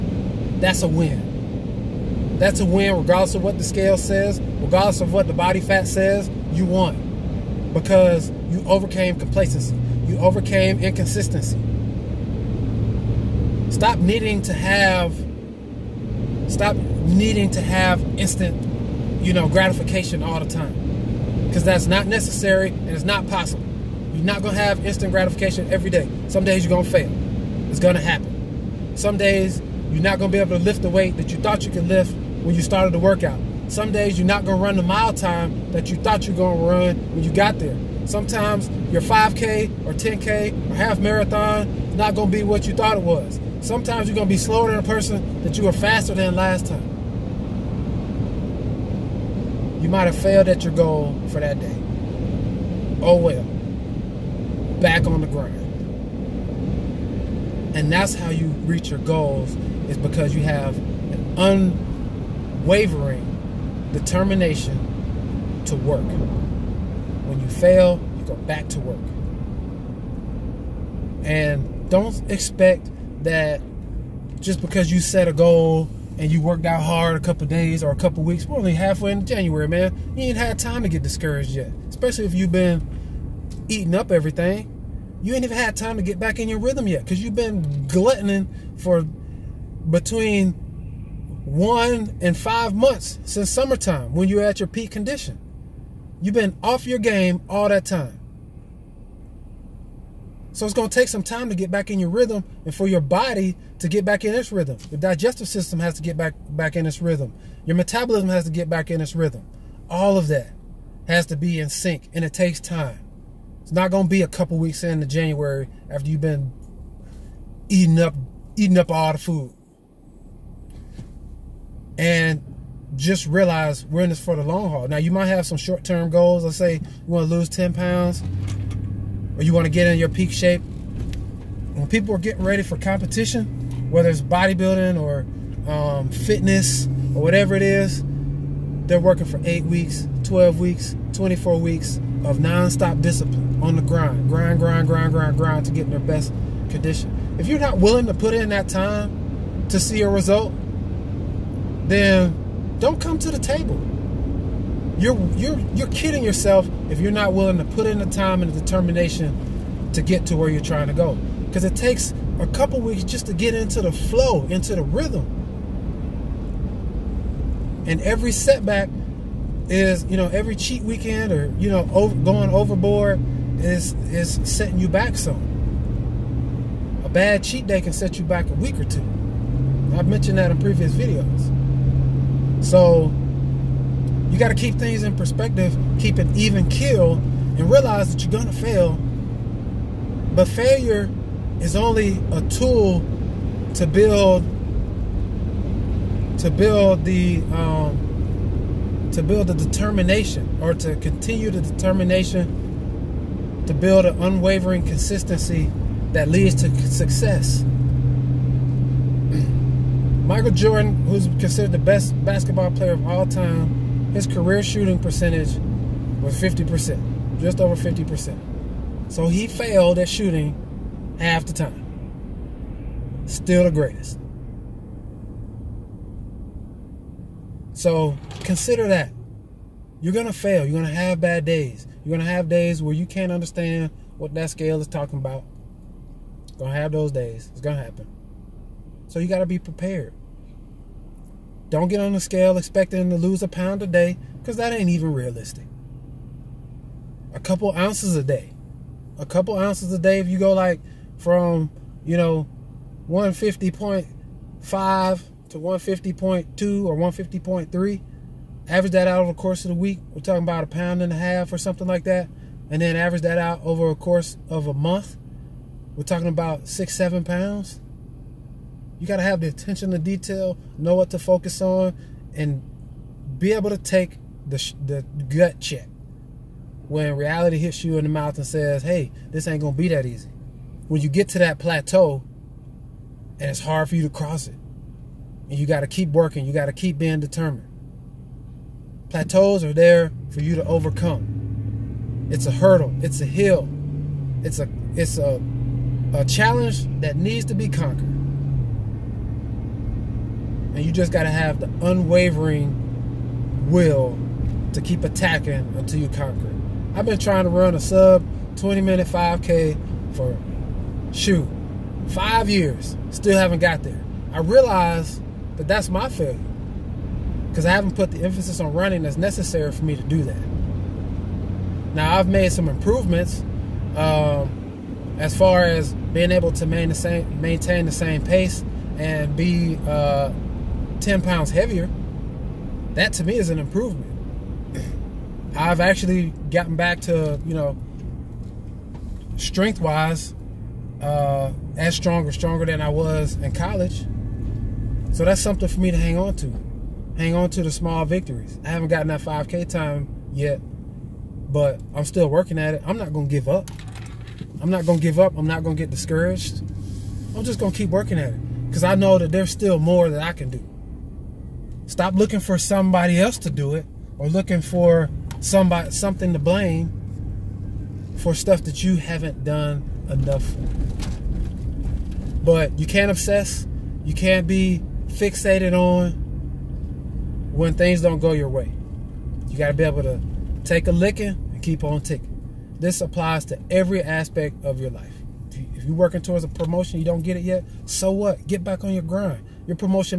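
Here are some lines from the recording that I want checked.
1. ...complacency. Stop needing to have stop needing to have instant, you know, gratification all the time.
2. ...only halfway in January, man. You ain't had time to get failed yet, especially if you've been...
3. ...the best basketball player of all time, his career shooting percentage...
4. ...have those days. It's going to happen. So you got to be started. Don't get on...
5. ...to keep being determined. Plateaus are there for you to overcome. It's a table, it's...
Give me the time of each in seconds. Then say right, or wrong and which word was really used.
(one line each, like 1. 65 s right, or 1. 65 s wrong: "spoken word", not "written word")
1. 10 s wrong: "inconsistency", not "complacency"
2. 78 s wrong: "discouraged", not "failed"
3. 211 s right
4. 236 s wrong: "prepared", not "started"
5. 286 s wrong: "hurdle", not "table".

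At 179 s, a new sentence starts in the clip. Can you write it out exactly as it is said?
I've mentioned that in previous videos.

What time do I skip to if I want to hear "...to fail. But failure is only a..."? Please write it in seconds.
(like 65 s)
188 s.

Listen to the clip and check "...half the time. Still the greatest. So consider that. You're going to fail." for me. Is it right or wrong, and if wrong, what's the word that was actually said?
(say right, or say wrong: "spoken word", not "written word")
right.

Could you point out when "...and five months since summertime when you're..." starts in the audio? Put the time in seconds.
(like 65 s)
92 s.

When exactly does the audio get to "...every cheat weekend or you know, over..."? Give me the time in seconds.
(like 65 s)
170 s.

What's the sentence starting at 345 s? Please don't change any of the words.
So that's something for me to hang on to.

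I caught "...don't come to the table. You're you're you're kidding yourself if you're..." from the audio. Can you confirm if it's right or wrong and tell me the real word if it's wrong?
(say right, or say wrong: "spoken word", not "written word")
right.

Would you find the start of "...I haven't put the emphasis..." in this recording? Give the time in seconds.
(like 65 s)
317 s.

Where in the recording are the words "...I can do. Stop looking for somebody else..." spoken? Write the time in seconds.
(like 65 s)
360 s.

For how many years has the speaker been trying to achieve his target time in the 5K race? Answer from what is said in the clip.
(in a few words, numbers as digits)
5 years.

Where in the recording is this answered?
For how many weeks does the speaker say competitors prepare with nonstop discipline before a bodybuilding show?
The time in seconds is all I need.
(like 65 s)
139 s.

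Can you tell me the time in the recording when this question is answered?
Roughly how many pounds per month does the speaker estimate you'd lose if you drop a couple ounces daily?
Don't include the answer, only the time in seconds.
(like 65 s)
266 s.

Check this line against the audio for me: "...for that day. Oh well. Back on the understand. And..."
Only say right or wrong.
wrong.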